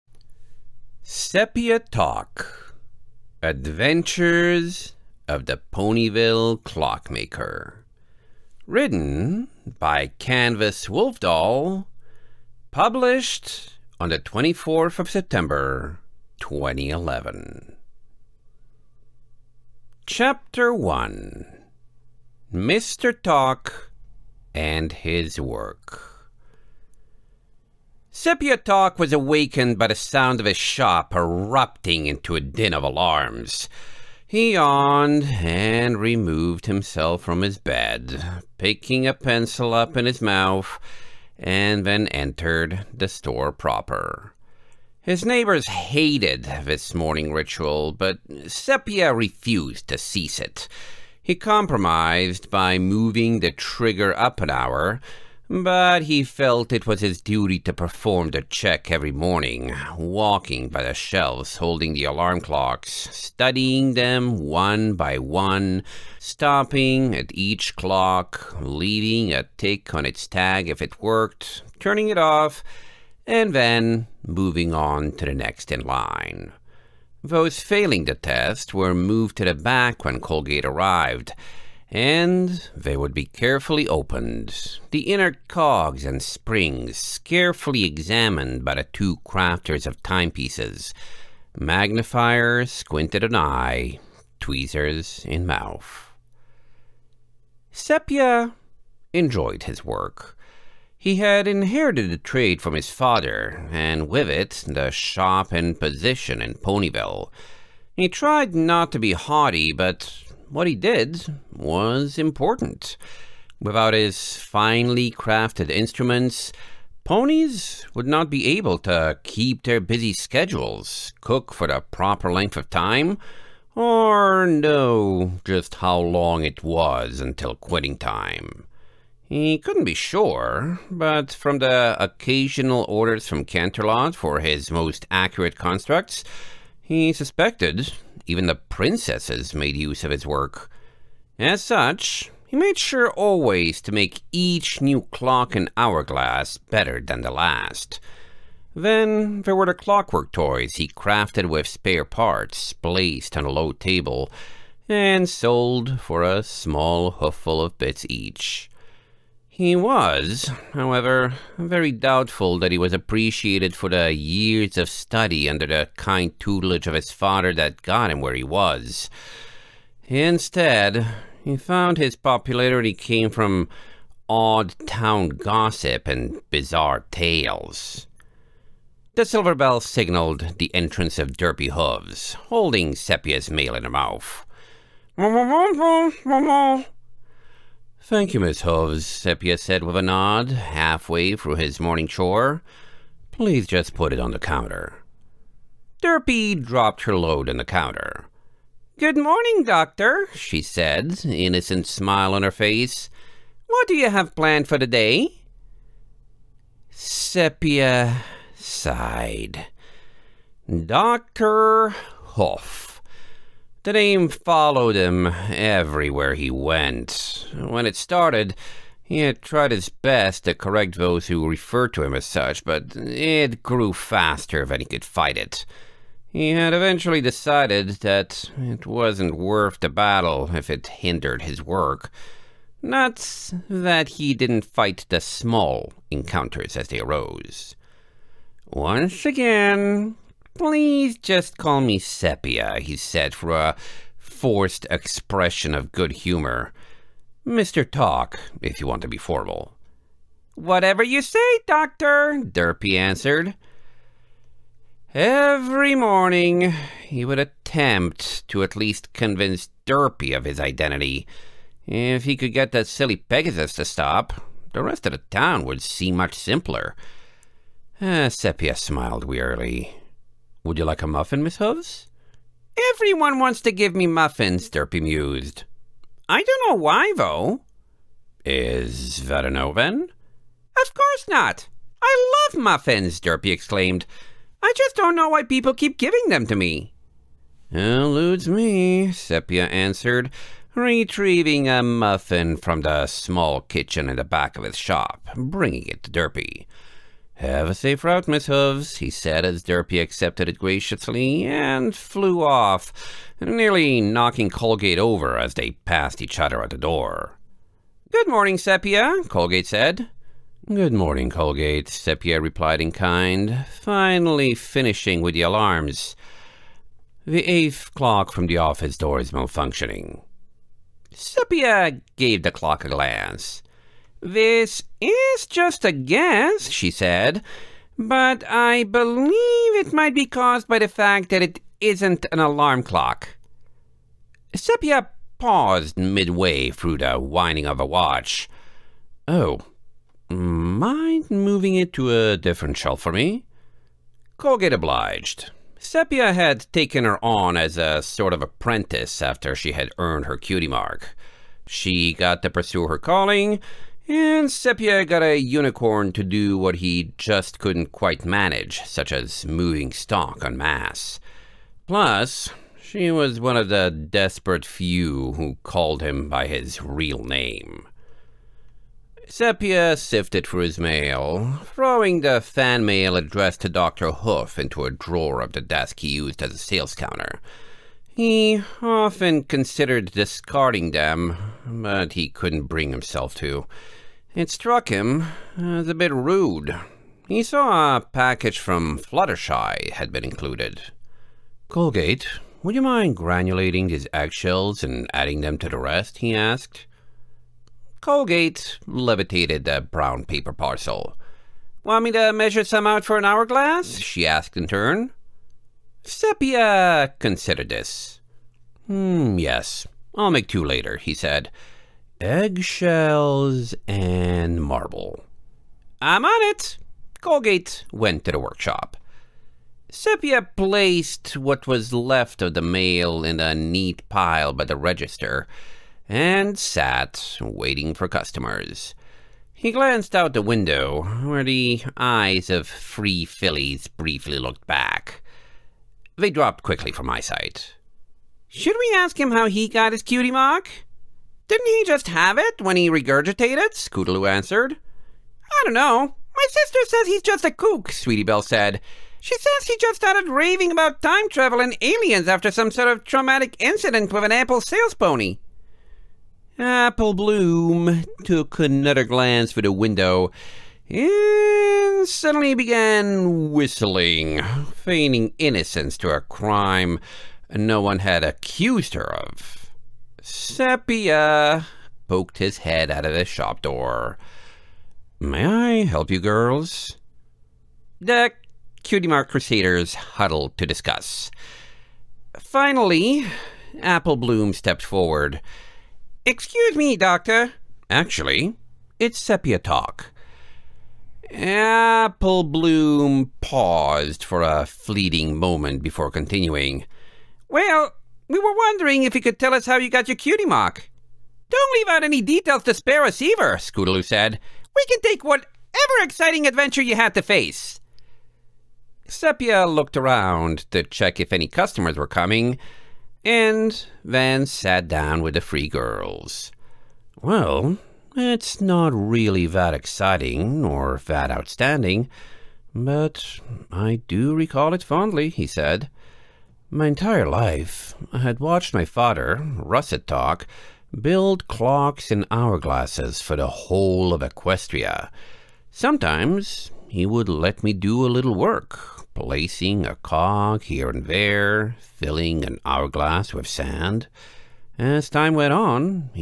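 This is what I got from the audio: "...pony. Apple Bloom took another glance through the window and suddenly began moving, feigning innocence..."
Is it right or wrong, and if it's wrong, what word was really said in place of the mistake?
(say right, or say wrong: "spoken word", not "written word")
wrong: "whistling", not "moving".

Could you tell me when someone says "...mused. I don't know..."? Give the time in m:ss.
4:35.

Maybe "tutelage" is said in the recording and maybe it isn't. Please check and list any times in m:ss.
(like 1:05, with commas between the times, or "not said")
2:46.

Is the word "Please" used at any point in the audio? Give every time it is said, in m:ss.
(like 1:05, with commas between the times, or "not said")
3:13, 4:00.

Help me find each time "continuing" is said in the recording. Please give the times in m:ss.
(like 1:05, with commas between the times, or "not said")
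8:16.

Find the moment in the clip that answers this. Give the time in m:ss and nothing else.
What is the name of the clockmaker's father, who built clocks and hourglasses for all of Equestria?
8:49.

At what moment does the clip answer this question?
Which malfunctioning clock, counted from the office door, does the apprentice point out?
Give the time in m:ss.
5:17.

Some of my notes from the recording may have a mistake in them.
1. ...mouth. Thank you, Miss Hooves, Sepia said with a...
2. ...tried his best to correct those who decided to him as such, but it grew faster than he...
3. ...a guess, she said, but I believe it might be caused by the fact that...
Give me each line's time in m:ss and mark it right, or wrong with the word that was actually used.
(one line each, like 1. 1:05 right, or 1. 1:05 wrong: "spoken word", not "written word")
1. 3:03 right
2. 3:39 wrong: "referred", not "decided"
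3. 5:25 right.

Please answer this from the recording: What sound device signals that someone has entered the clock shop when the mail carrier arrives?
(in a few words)
Silver bell.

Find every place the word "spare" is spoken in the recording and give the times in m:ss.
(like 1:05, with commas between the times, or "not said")
2:31, 8:22.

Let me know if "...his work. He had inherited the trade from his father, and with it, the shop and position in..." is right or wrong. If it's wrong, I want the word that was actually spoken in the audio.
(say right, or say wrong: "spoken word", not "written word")
right.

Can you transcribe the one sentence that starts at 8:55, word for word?
Sometimes he would let me do a little work, placing a cog here and there, filling an hourglass with sand.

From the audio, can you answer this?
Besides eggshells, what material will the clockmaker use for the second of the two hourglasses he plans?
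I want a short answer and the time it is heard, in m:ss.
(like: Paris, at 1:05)
Marble, at 6:54.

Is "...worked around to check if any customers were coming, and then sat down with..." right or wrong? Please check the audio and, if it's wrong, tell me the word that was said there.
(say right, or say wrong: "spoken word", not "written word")
wrong: "looked", not "worked".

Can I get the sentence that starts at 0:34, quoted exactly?
He yawned and removed himself from his bed, picking a pencil up in his mouth, and then entered the store proper.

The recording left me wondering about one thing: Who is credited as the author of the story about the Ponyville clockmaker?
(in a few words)
Canvas Wolfdoll.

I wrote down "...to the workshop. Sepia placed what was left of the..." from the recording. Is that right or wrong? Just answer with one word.
right.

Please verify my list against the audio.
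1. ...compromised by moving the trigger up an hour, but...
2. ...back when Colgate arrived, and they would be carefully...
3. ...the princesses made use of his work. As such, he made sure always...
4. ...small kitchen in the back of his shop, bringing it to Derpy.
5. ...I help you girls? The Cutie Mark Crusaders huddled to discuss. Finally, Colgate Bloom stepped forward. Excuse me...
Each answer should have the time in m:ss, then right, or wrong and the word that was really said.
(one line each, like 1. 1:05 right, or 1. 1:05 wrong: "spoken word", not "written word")
1. 0:51 right
2. 1:19 right
3. 2:18 right
4. 4:53 right
5. 7:55 wrong: "Apple", not "Colgate".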